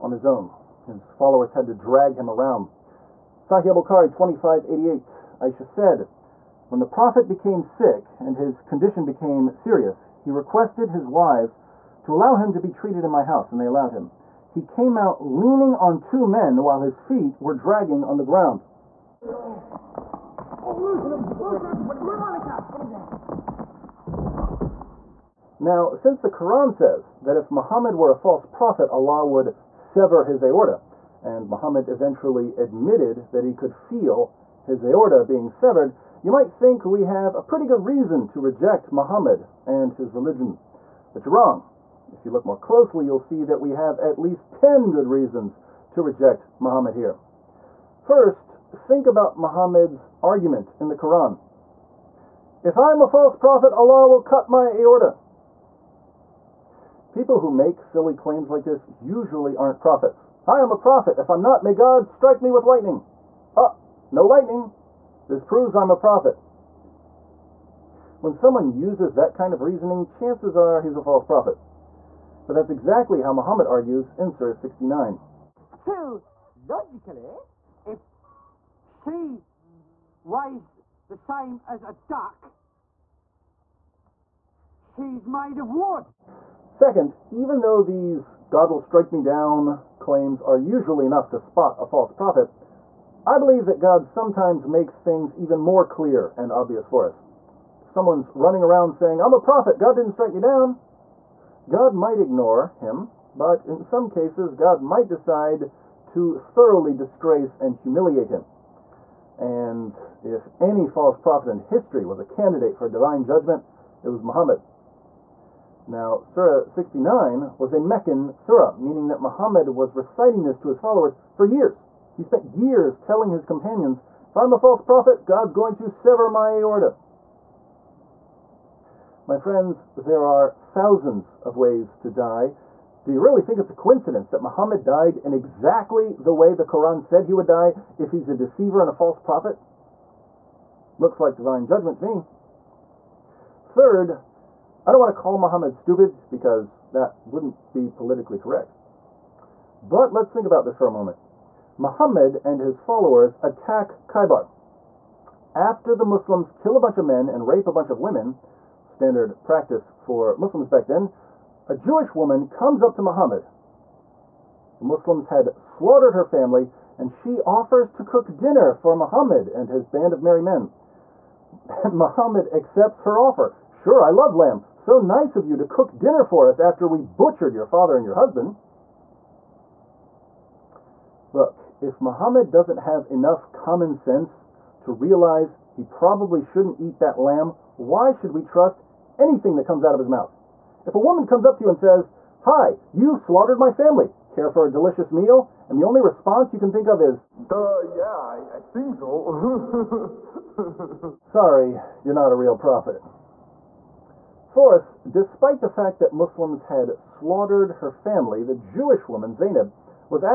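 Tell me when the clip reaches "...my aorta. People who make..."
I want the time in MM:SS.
00:54.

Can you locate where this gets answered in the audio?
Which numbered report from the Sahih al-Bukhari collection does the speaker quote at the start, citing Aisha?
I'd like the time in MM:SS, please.
00:04.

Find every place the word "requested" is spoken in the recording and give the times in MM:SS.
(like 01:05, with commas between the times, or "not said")
00:10.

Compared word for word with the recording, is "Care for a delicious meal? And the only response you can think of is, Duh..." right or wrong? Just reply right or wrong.
right.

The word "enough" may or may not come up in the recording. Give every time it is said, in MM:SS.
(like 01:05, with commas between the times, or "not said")
01:31, 03:03.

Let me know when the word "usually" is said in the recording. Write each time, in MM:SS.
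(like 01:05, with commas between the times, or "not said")
00:58, 01:30.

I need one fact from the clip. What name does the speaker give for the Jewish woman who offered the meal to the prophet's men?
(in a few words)
Zainab.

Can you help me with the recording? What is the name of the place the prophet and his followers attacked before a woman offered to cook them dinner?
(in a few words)
Khaibar.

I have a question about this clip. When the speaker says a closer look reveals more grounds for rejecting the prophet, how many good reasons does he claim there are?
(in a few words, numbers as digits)
10.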